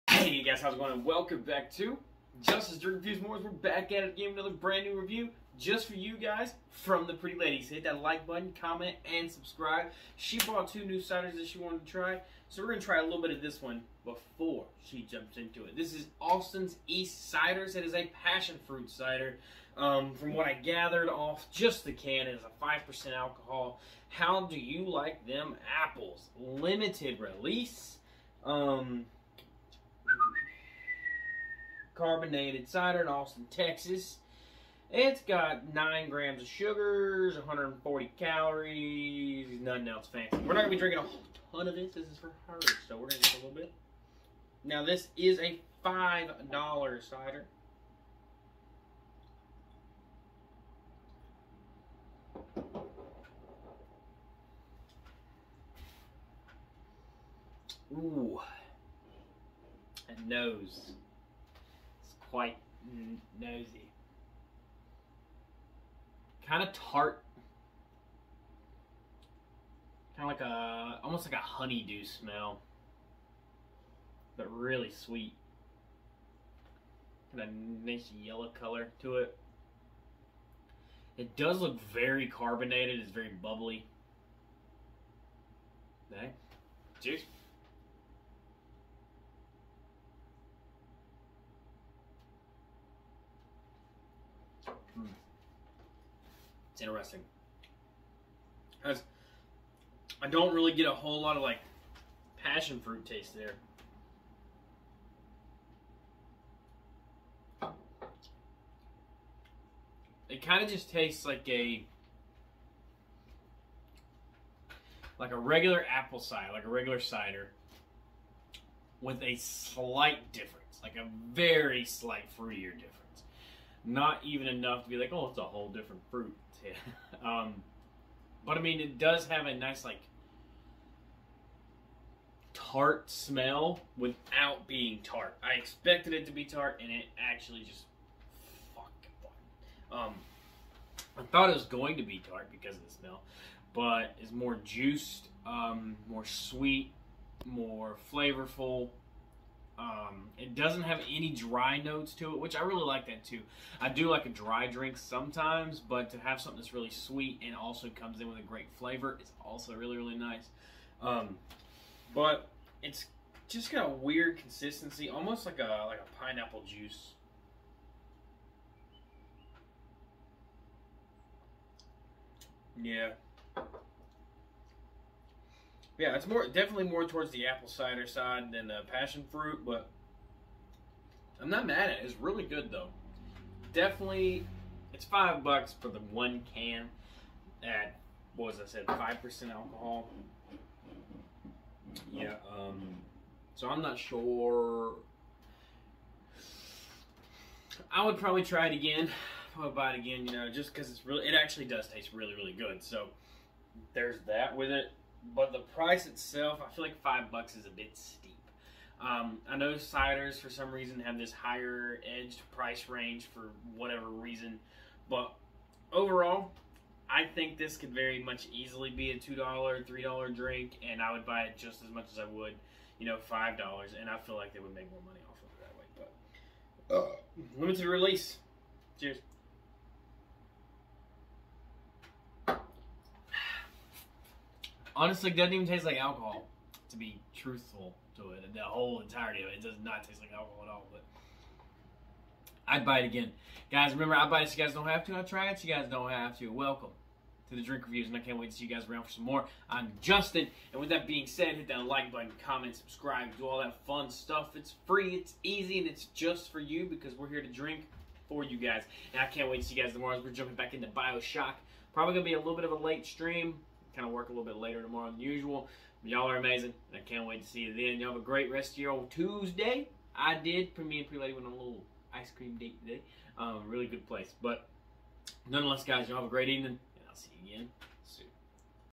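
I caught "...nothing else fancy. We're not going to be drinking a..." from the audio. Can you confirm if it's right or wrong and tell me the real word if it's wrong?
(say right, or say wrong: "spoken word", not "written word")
right.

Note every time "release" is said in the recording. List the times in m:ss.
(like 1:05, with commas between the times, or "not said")
0:27, 3:47.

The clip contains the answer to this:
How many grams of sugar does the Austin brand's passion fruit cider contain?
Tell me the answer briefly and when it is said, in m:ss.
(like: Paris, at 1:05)
9 grams, at 0:35.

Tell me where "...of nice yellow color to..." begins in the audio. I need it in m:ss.
1:17.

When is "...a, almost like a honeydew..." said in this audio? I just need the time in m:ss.
1:10.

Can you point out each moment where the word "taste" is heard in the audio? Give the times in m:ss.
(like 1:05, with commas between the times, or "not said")
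1:43, 1:50, 3:21, 3:55, 4:00.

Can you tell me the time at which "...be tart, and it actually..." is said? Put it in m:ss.
2:16.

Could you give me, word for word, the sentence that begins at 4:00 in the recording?
But I'd buy it again, guys.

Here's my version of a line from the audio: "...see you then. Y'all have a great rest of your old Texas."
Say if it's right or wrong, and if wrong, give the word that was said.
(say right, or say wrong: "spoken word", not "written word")
wrong: "Tuesday", not "Texas".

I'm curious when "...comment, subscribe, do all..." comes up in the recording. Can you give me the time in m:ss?
4:12.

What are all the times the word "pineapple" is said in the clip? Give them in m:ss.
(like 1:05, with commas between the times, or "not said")
2:46.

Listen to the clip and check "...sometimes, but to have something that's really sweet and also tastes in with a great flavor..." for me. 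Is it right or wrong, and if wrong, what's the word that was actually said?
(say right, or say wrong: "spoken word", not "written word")
wrong: "comes", not "tastes".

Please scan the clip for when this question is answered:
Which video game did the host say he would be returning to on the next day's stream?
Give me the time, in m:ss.
4:20.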